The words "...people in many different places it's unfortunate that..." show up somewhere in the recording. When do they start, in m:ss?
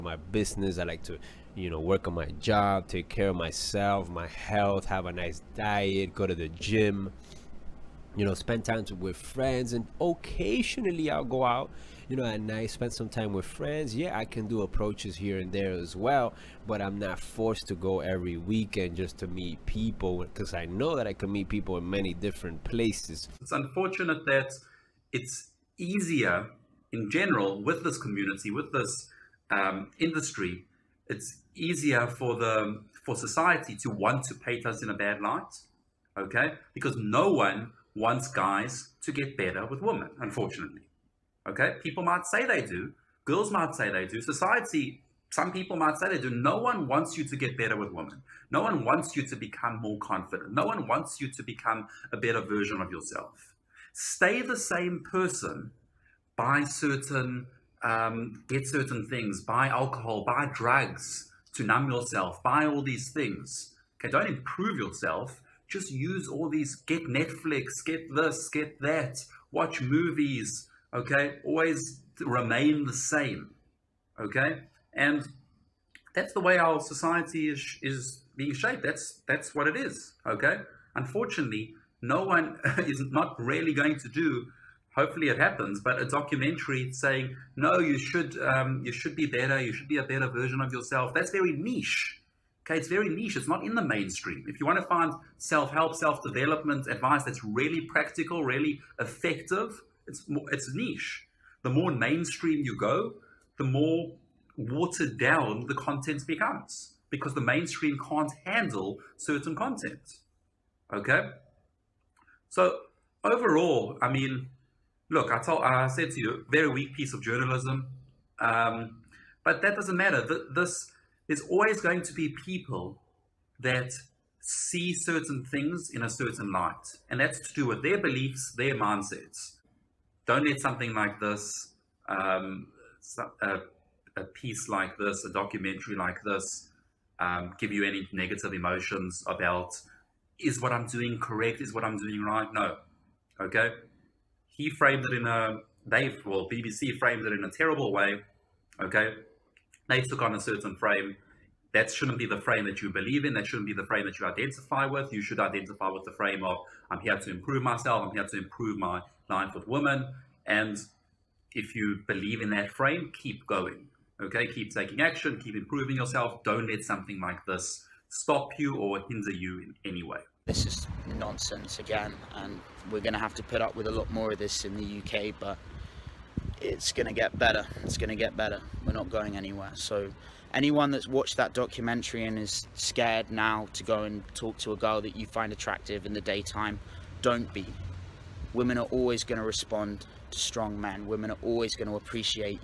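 0:21.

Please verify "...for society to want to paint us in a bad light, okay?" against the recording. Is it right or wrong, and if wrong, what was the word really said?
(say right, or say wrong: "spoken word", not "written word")
right.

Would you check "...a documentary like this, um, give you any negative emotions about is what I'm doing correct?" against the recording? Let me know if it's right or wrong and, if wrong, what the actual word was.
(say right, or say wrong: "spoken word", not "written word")
right.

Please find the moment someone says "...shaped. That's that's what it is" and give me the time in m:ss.
1:18.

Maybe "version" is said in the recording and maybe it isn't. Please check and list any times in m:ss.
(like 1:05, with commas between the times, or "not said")
0:52, 1:30.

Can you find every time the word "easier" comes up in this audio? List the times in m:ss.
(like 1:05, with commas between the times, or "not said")
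0:25, 0:31.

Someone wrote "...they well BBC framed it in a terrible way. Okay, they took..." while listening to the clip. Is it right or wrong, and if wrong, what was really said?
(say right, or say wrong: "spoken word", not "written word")
right.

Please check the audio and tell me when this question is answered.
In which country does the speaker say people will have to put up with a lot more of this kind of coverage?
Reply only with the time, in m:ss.
2:54.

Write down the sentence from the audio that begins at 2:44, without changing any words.
Okay, keep taking action, keep improving yourself.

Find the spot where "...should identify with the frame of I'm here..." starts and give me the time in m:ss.
2:35.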